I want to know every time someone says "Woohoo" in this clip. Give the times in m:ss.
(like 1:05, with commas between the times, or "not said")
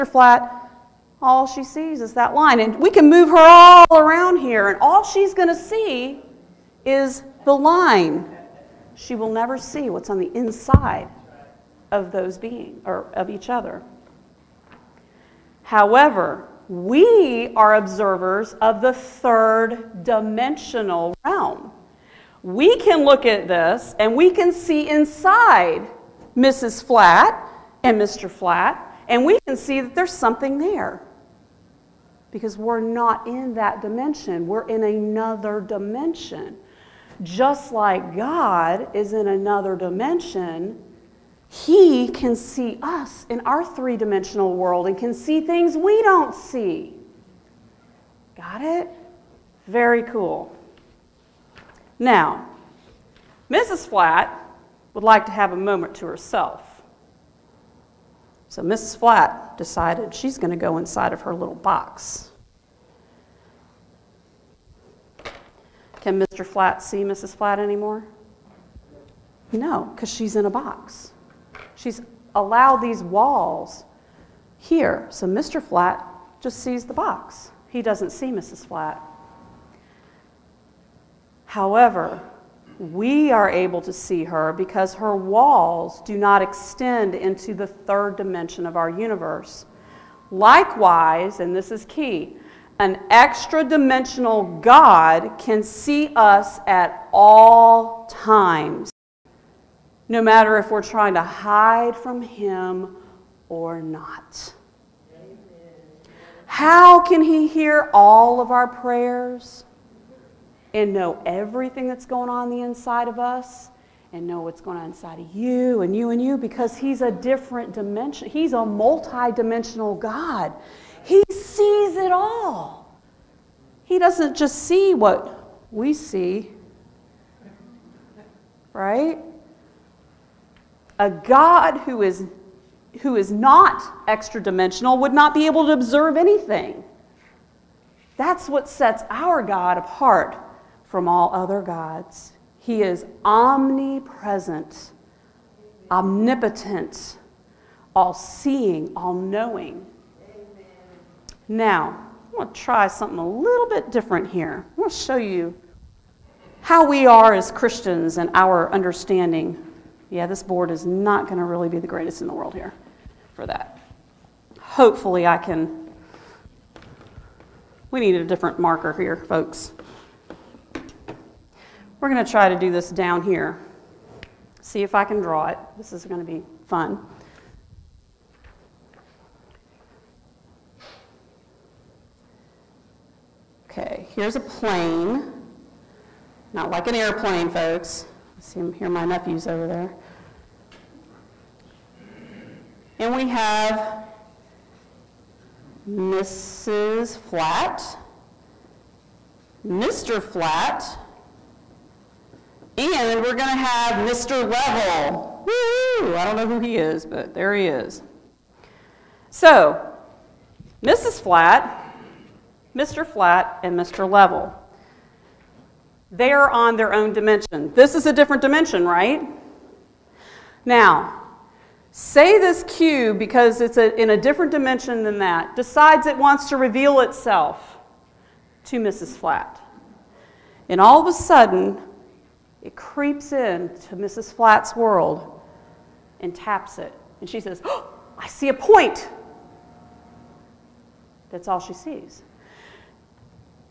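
3:25.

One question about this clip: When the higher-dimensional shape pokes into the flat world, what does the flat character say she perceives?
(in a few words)
a point.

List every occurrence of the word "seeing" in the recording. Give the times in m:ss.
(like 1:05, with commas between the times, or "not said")
2:28.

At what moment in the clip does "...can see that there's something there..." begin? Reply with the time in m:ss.
0:29.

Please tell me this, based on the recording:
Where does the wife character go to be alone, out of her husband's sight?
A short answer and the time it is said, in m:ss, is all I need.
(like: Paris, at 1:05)
her little box, at 1:01.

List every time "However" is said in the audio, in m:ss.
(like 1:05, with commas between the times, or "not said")
0:15, 1:21.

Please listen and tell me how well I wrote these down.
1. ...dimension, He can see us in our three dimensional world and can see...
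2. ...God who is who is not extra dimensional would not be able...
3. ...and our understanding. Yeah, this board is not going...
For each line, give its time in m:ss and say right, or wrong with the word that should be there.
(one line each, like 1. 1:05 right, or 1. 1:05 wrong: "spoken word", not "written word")
1. 0:39 right
2. 2:11 right
3. 2:38 right.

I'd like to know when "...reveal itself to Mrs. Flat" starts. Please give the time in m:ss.
3:46.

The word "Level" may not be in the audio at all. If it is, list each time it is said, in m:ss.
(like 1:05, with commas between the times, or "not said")
3:24, 3:34.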